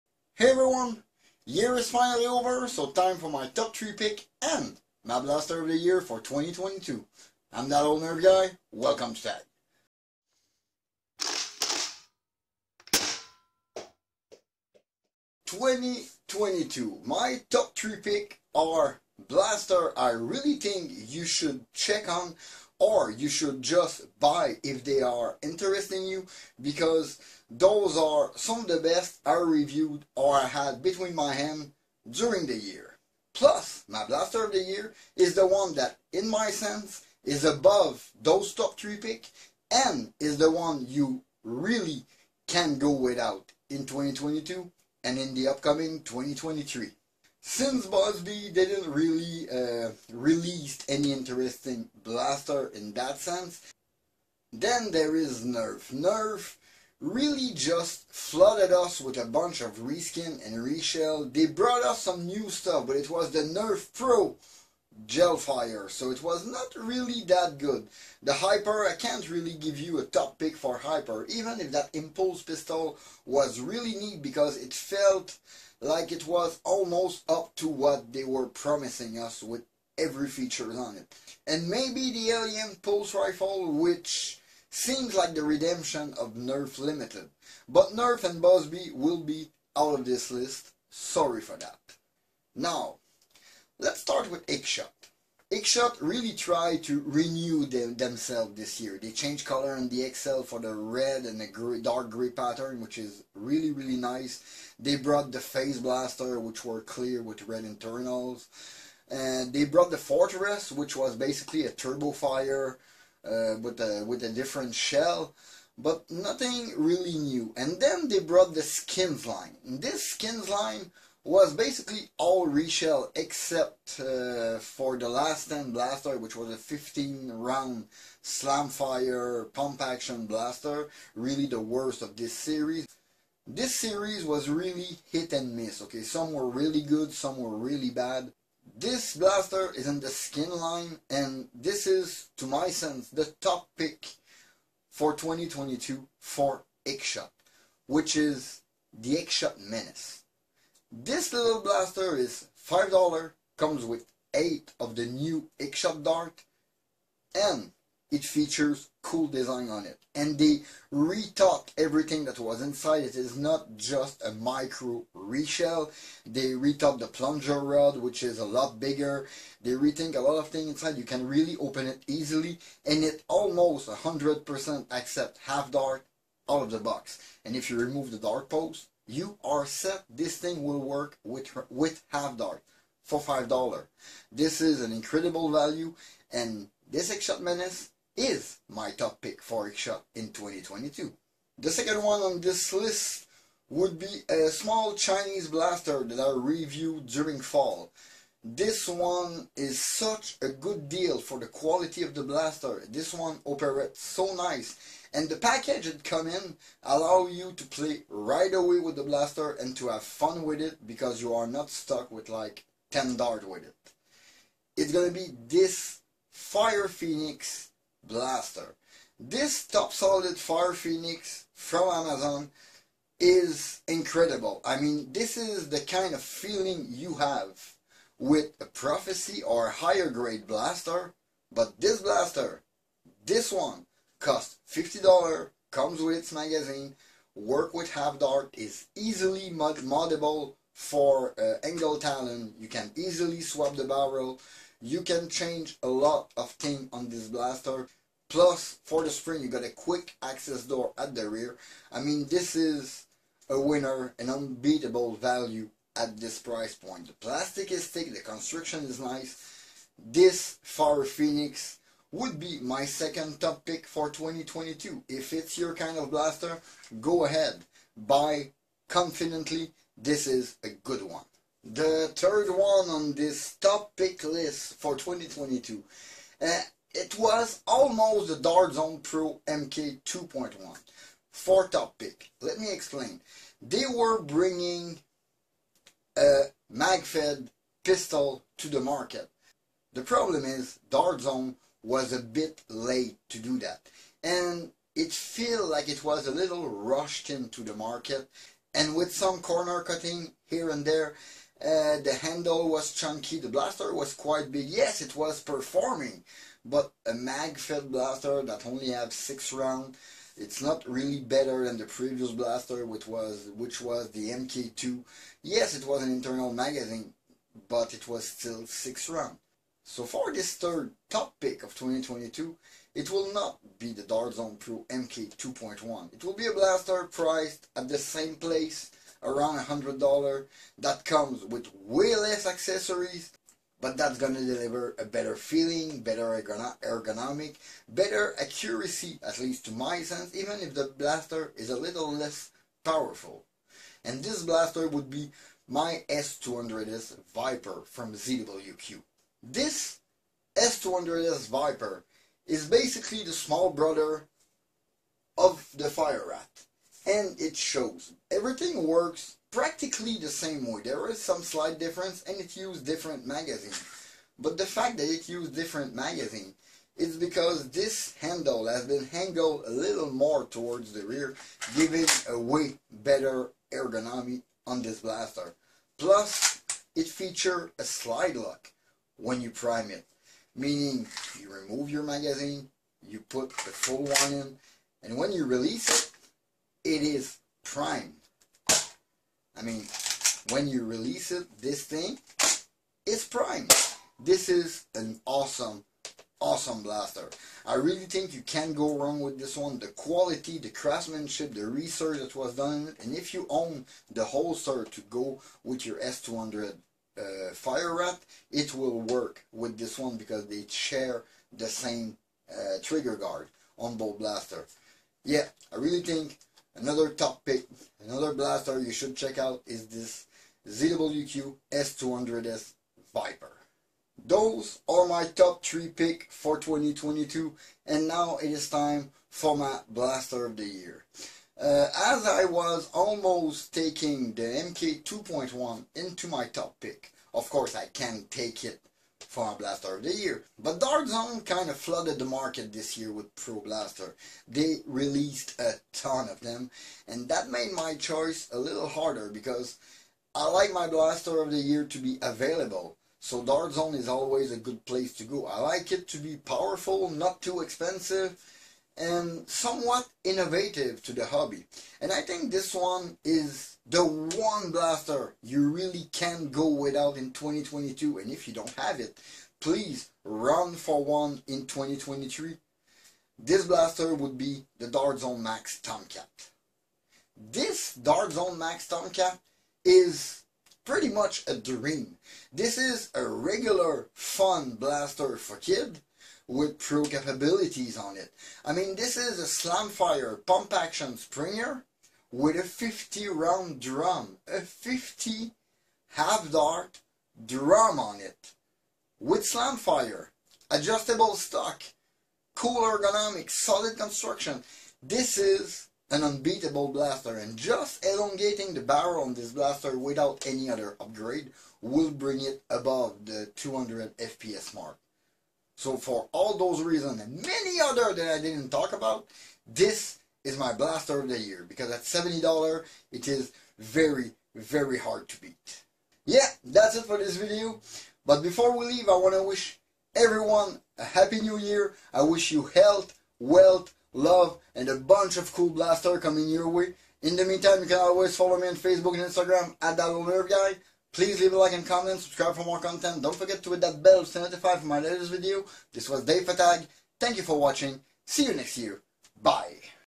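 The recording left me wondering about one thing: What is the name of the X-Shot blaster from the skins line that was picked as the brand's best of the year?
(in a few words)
X-Shot Menace.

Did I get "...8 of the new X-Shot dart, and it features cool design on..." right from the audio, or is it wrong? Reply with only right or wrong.
right.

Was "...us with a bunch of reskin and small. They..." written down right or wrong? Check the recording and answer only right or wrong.
wrong.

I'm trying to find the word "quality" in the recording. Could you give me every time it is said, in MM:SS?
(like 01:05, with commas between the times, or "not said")
03:21, 06:39.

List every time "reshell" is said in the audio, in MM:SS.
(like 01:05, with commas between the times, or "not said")
01:00, 02:02, 02:45.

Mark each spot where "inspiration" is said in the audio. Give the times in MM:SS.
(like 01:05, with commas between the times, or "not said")
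not said.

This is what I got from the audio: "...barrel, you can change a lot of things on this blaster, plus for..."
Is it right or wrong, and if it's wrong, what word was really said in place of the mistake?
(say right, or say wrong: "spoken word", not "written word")
right.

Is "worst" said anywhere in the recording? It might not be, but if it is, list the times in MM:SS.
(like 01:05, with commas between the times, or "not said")
02:11.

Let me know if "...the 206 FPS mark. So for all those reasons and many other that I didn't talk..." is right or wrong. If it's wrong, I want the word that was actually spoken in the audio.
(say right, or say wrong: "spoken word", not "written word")
wrong: "200", not "206".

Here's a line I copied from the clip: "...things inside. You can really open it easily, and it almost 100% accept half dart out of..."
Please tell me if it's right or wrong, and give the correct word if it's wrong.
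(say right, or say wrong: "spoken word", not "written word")
right.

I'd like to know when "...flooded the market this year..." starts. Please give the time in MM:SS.
07:21.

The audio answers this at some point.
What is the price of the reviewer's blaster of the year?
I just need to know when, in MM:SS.
08:42.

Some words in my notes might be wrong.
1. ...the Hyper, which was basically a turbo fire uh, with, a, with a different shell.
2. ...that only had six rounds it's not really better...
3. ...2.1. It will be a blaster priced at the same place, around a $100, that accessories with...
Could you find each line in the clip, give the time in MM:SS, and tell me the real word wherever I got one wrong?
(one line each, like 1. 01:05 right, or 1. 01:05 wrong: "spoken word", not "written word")
1. 01:49 wrong: "Fortress", not "Hyper"
2. 05:08 right
3. 05:25 wrong: "comes", not "accessories".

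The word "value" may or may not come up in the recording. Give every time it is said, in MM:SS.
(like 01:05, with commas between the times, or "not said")
03:05, 04:15.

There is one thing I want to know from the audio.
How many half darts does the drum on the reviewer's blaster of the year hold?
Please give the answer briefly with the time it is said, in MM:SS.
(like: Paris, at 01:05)
50, at 08:12.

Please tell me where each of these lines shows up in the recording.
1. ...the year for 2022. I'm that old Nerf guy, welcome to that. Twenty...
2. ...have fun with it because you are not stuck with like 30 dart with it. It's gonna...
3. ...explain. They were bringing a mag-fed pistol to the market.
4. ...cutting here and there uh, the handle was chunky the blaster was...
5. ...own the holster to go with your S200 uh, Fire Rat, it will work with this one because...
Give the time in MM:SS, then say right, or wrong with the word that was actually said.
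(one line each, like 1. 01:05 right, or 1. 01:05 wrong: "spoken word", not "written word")
1. 00:05 right
2. 03:29 wrong: "10", not "30"
3. 04:42 right
4. 04:59 right
5. 06:43 right.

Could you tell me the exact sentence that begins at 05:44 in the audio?
And this blaster would be my S200S Viper from ZWQ.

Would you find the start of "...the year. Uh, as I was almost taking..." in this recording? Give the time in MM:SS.
07:10.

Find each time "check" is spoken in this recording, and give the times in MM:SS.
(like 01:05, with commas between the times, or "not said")
00:21, 06:59.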